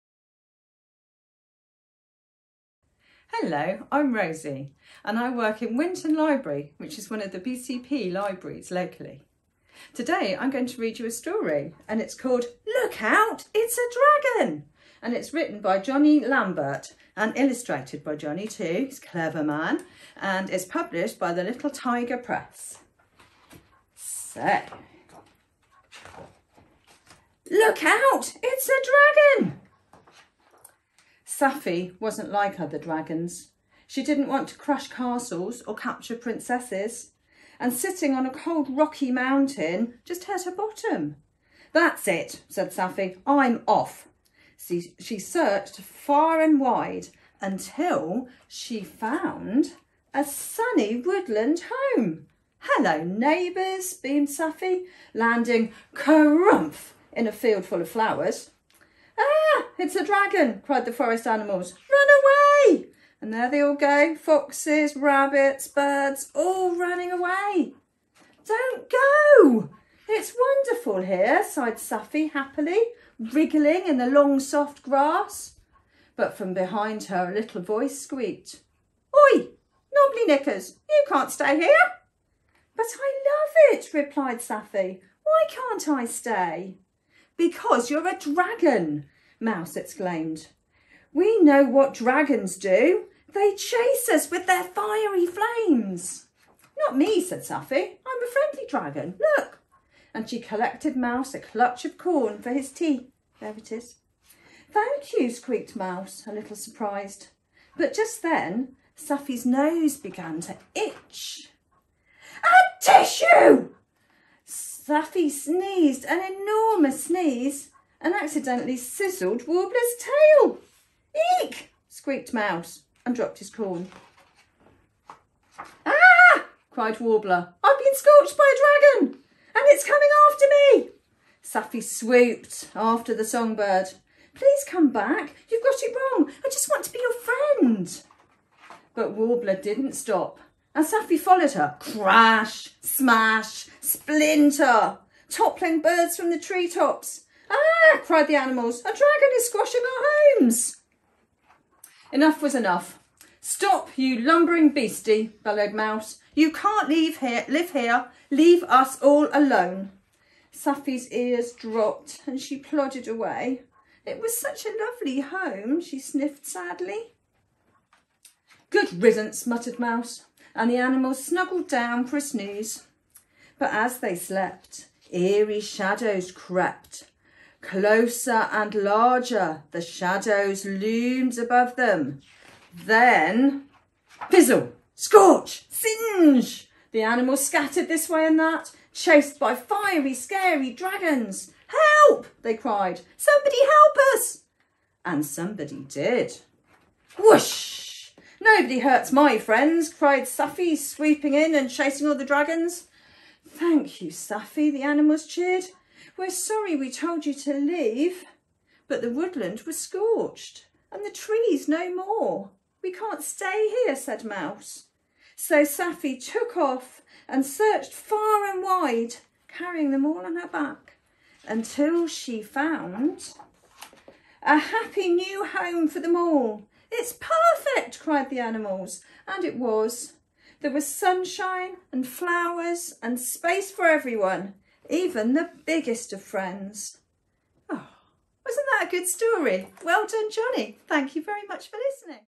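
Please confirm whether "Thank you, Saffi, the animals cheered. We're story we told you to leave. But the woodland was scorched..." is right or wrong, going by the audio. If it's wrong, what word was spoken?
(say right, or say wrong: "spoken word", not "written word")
wrong: "sorry", not "story".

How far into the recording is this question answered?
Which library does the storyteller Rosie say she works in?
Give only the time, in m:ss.
0:05.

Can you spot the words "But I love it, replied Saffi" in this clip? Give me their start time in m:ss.
1:22.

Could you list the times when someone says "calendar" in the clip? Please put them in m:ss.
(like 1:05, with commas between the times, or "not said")
not said.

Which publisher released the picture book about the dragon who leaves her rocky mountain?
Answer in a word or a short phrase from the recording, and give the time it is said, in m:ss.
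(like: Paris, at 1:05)
Little Tiger Press, at 0:21.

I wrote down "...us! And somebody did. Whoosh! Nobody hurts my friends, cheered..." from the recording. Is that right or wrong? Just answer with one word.
wrong.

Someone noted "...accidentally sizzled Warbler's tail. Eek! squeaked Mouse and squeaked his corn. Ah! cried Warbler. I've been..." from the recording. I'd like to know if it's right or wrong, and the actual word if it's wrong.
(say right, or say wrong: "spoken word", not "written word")
wrong: "dropped", not "squeaked".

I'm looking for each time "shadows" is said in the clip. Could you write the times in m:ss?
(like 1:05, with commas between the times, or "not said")
2:55, 2:59.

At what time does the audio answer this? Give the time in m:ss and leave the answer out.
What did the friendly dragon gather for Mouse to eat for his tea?
1:41.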